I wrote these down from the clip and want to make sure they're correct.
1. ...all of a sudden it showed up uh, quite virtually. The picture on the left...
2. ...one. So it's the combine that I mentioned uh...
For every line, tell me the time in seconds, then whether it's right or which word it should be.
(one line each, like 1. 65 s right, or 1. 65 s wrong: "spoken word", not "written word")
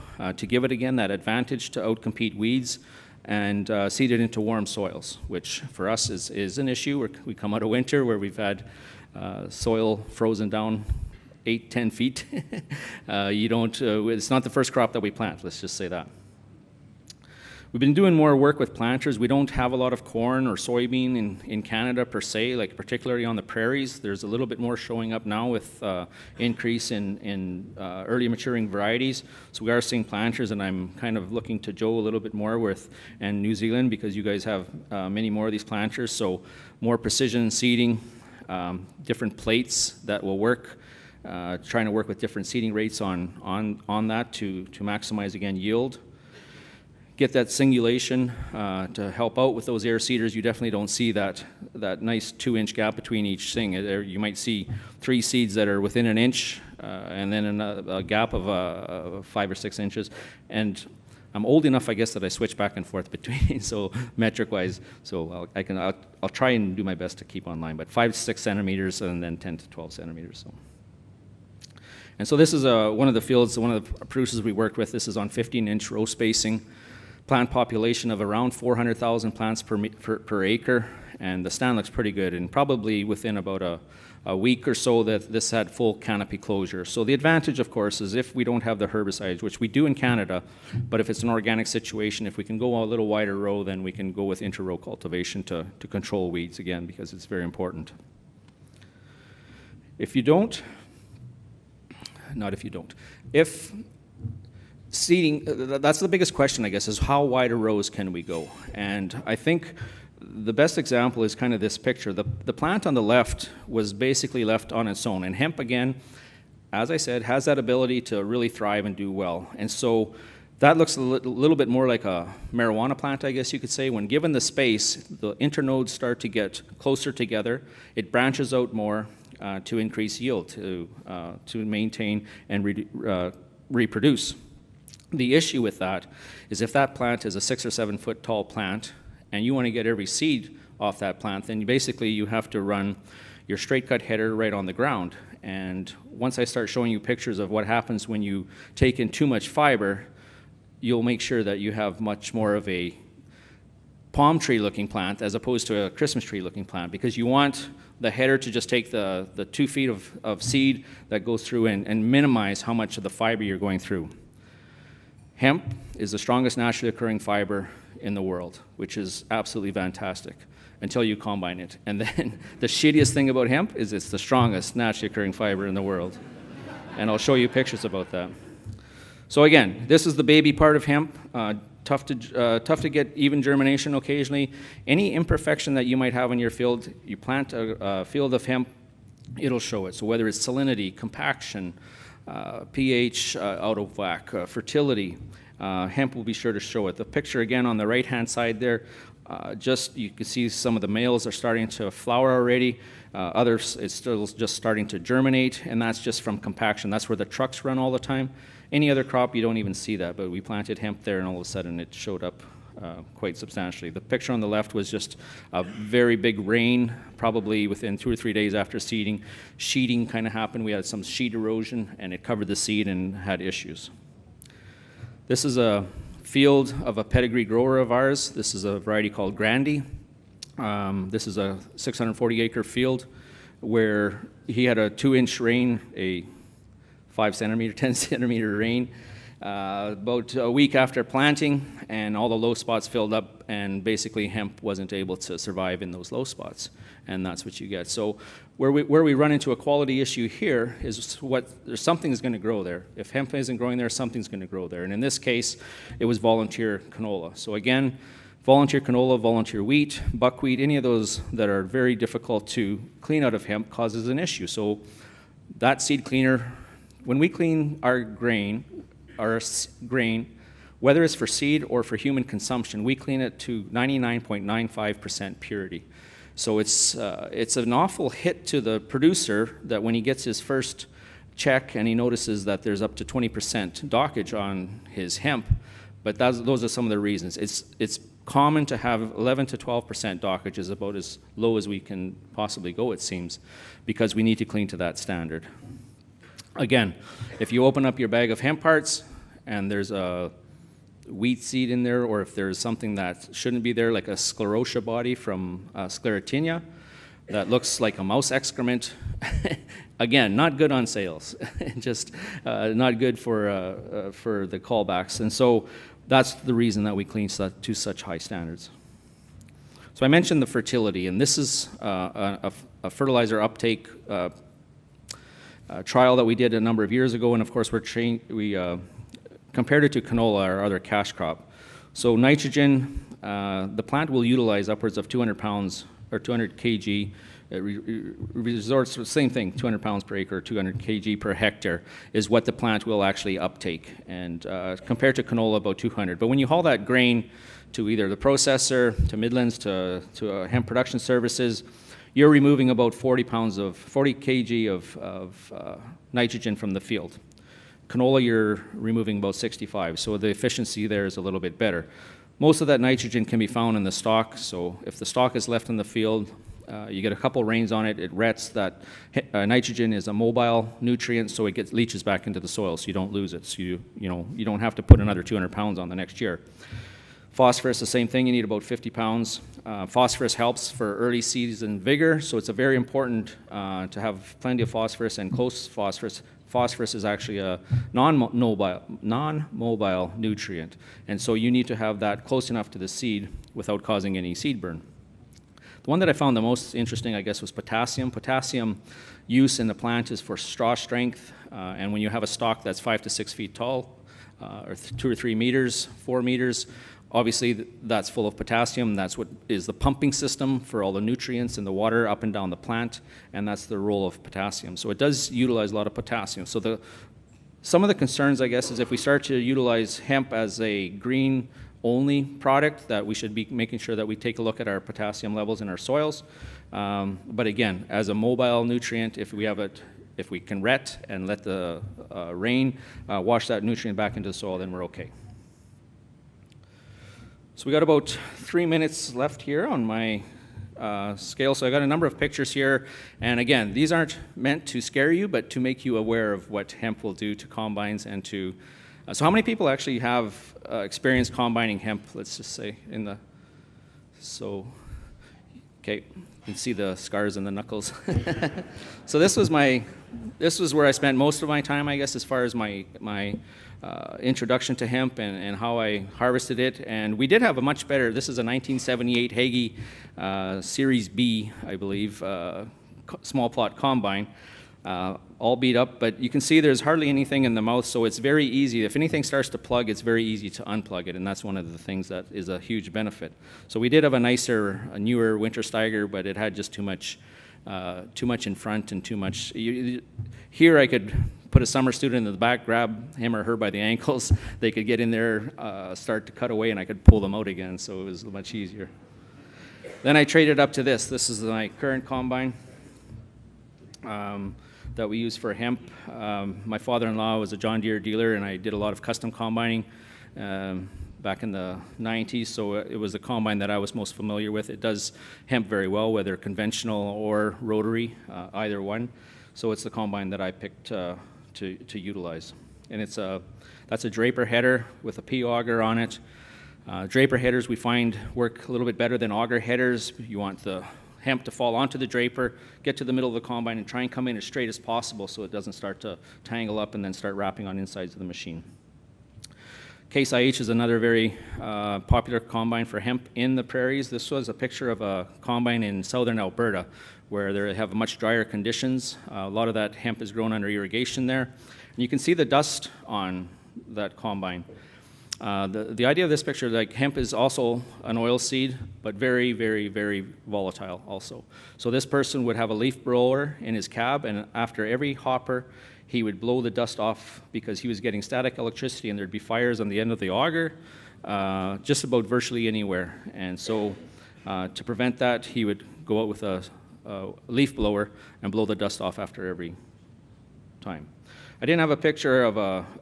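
1. 211 s wrong: "substantially", not "virtually"
2. 518 s wrong: "picked", not "mentioned".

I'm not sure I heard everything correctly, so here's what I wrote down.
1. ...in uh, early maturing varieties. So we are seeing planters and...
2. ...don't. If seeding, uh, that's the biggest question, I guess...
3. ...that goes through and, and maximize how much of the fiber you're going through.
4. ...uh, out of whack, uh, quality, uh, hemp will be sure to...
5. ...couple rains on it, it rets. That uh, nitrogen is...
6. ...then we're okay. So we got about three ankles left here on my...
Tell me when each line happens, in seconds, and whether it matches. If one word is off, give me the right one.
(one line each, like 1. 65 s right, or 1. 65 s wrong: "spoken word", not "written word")
1. 27 s right
2. 102 s right
3. 161 s wrong: "minimize", not "maximize"
4. 193 s wrong: "fertility", not "quality"
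5. 367 s right
6. 434 s wrong: "minutes", not "ankles".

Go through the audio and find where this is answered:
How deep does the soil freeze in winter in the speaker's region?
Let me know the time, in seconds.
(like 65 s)
11 s.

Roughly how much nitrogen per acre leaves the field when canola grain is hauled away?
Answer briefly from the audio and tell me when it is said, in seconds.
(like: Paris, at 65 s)
65 pounds, at 359 s.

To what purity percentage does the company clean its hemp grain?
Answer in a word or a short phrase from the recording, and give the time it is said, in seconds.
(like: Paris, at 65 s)
99.95%, at 273 s.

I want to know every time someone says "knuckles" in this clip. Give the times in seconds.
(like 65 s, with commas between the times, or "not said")
457 s.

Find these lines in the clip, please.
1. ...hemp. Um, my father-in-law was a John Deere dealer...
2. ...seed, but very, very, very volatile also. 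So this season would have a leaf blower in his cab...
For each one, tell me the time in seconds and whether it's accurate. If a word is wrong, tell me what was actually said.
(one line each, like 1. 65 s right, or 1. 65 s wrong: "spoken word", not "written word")
1. 505 s right
2. 558 s wrong: "person", not "season".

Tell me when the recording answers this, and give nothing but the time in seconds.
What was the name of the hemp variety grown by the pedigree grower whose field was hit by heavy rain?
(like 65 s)
229 s.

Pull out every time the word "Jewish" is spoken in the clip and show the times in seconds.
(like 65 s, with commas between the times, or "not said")
not said.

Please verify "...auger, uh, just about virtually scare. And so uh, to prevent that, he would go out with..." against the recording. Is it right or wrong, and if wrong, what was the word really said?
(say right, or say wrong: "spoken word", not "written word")
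wrong: "anywhere", not "scare".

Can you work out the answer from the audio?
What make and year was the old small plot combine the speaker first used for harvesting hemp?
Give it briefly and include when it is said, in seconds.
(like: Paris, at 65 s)
1978 Hege, at 468 s.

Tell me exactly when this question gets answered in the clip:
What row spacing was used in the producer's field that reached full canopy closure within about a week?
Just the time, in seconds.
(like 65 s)
75 s.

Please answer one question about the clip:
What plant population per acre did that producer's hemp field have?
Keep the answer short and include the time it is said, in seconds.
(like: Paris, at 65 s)
400,000, at 78 s.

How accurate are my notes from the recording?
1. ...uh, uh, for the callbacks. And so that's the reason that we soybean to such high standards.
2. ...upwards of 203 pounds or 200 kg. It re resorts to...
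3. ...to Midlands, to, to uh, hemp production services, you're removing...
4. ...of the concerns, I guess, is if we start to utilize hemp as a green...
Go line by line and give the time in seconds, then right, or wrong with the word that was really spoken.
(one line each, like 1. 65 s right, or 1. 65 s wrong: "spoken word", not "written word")
1. 313 s wrong: "clean", not "soybean"
2. 334 s wrong: "200", not "203"
3. 349 s right
4. 417 s right.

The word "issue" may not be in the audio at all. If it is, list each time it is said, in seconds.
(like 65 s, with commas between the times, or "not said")
6 s, 135 s, 223 s, 249 s, 264 s.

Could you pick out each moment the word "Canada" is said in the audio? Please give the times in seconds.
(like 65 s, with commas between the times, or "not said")
21 s, 89 s.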